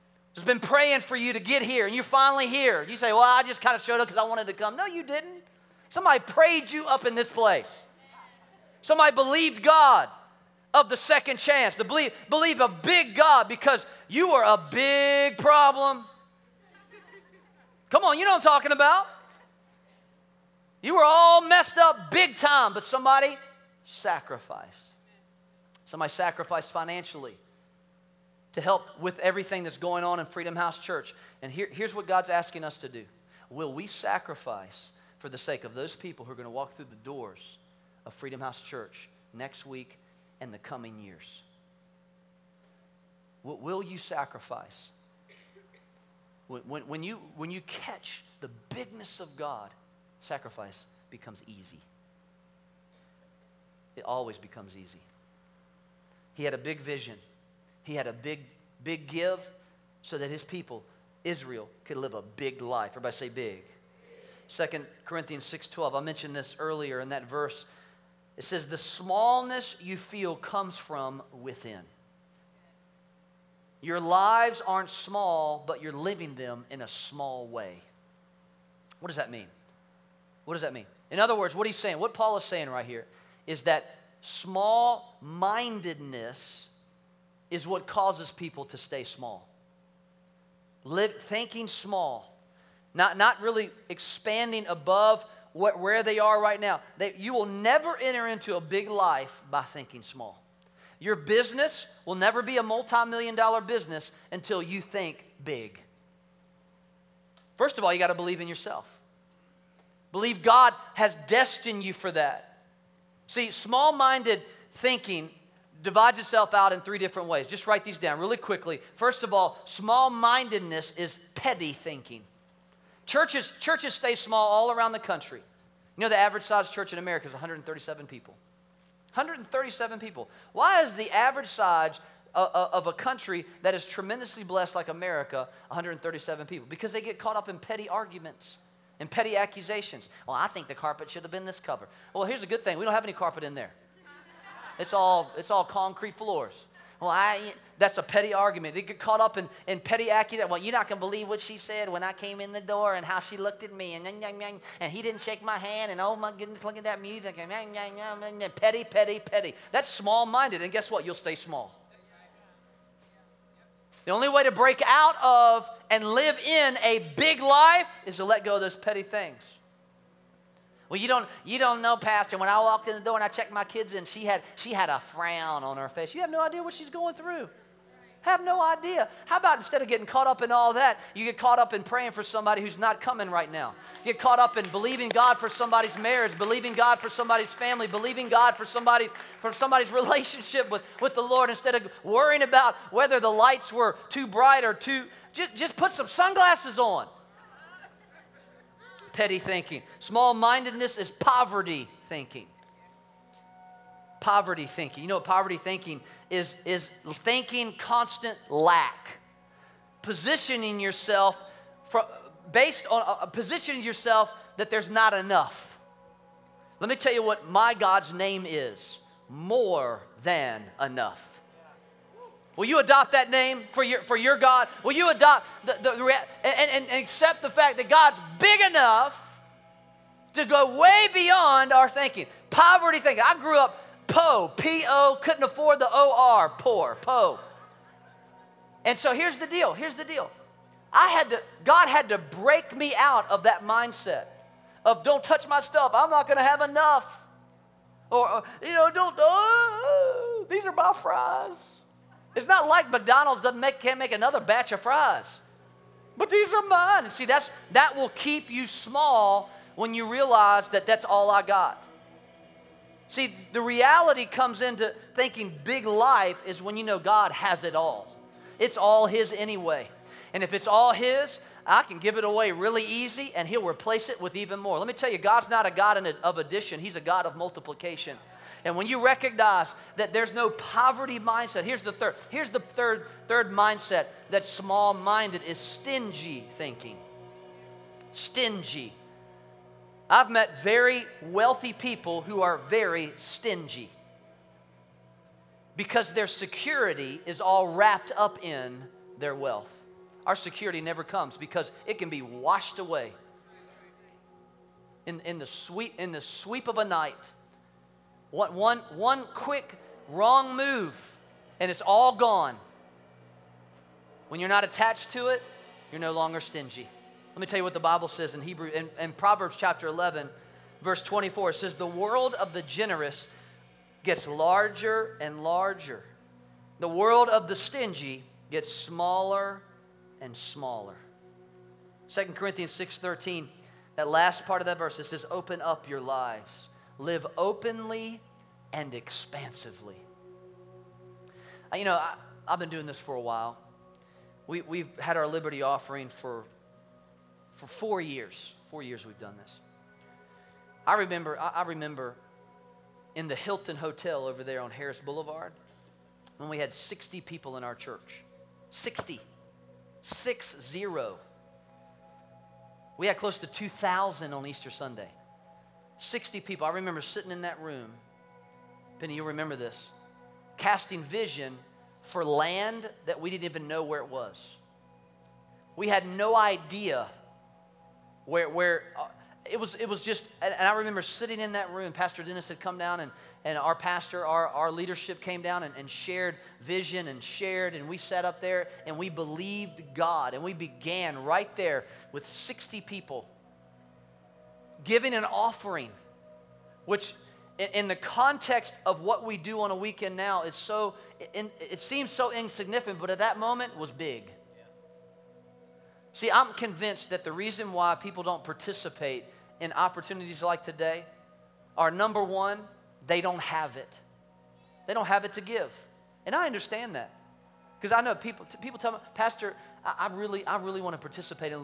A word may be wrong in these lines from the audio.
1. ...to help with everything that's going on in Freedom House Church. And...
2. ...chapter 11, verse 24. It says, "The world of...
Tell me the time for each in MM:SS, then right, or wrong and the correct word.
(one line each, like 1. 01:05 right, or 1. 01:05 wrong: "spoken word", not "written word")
1. 00:28 right
2. 05:19 right.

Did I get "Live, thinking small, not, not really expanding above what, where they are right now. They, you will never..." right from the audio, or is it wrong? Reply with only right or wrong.
right.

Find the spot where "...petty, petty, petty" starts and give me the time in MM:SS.
02:38.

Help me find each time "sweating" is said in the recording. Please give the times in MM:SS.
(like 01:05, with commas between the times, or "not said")
not said.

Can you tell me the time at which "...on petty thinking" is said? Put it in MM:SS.
03:16.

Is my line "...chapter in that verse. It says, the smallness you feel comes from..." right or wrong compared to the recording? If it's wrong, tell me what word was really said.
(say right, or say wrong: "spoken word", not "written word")
wrong: "earlier", not "chapter".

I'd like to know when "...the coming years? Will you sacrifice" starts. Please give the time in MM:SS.
00:40.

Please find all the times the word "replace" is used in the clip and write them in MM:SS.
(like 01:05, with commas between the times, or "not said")
04:33.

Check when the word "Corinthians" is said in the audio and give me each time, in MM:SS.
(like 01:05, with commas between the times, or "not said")
01:05, 05:32.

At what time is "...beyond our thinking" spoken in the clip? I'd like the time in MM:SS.
03:51.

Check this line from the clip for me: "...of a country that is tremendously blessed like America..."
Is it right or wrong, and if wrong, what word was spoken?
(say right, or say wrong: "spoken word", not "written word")
right.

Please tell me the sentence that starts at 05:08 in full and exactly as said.
One, one, one quick wrong move, and it's all gone.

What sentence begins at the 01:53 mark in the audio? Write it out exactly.
See, small minded thinking divides itself out in three different ways.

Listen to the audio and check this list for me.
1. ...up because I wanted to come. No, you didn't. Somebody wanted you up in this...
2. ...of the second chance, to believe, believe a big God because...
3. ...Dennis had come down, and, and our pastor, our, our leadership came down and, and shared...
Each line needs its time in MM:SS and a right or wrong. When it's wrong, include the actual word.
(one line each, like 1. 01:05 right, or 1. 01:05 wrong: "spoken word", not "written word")
1. 00:03 wrong: "prayed", not "wanted"
2. 00:10 right
3. 06:22 right.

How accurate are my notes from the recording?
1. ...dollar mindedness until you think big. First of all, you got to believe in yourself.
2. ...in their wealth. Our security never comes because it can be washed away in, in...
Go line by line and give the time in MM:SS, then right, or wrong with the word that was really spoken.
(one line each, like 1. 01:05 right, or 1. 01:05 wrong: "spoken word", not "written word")
1. 01:43 wrong: "business", not "mindedness"
2. 04:58 right.